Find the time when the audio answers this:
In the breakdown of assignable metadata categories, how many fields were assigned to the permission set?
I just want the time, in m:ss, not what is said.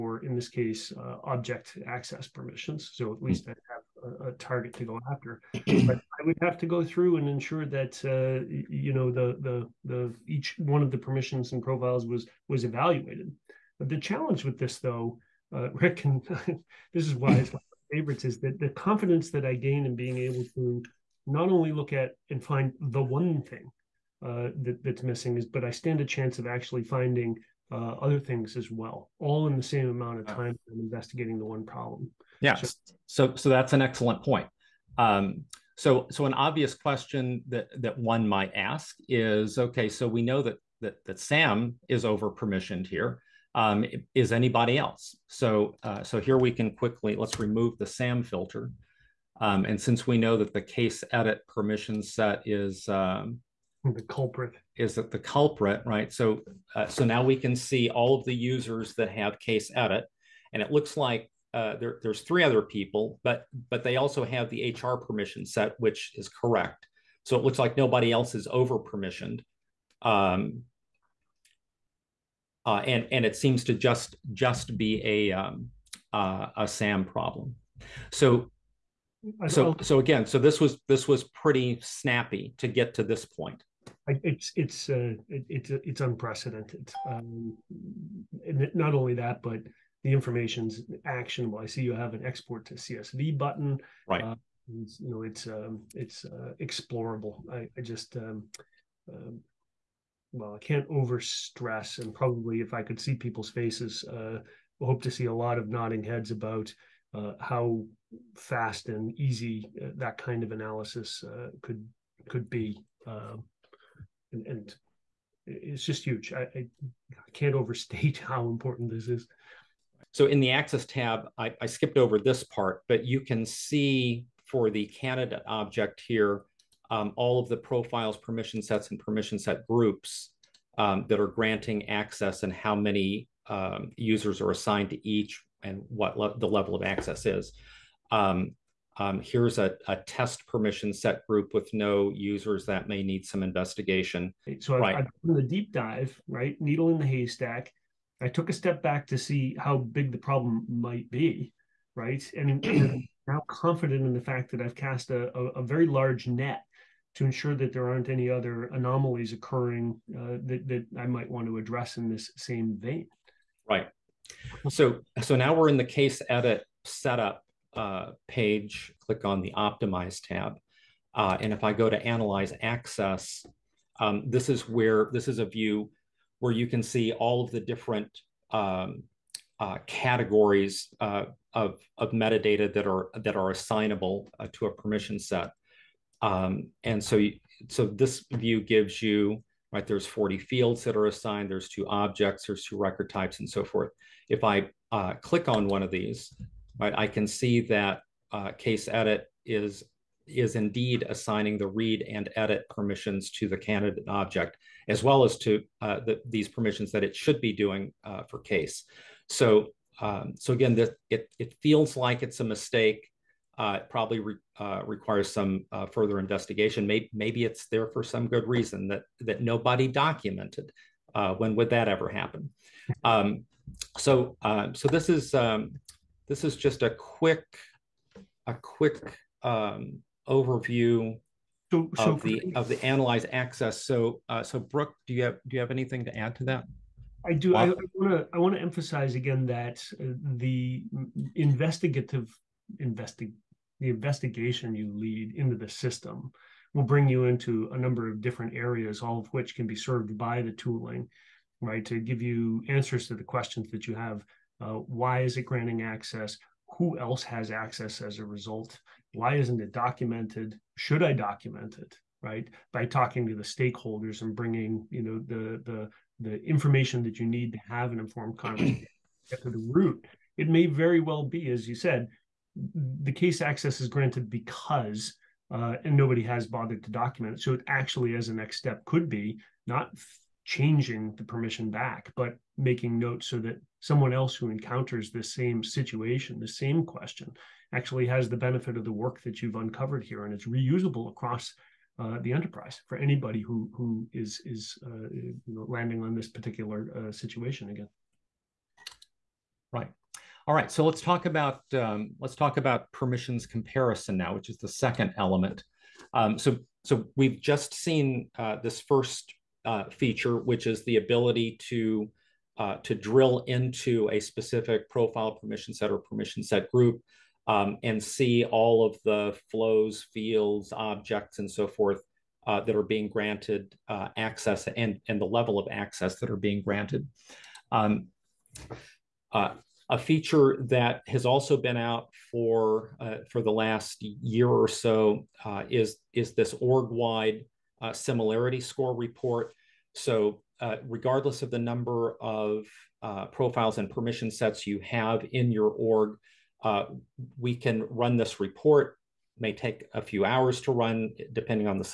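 3:10.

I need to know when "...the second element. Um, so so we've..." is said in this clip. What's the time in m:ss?
5:04.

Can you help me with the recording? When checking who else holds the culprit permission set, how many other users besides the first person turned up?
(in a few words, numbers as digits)
3.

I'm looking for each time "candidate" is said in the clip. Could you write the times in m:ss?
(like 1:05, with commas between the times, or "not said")
2:04, 3:23.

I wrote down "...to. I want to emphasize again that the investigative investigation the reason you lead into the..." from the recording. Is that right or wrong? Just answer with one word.
wrong.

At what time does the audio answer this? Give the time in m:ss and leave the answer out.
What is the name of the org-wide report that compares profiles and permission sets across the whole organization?
5:37.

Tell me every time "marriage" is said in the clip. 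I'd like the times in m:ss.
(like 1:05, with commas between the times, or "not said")
not said.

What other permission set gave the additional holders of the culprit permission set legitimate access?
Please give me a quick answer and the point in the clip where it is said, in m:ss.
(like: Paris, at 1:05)
HR, at 1:04.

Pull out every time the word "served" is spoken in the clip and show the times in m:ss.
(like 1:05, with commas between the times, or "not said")
4:09.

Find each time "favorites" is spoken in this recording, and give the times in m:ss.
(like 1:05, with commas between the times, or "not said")
0:17.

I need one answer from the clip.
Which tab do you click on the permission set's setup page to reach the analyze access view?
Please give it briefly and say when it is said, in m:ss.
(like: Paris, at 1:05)
optimize, at 2:49.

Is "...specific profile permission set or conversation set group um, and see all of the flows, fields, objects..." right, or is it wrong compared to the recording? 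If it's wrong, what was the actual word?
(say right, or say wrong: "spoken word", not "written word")
wrong: "permission", not "conversation".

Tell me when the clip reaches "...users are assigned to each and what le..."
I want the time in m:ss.
2:13.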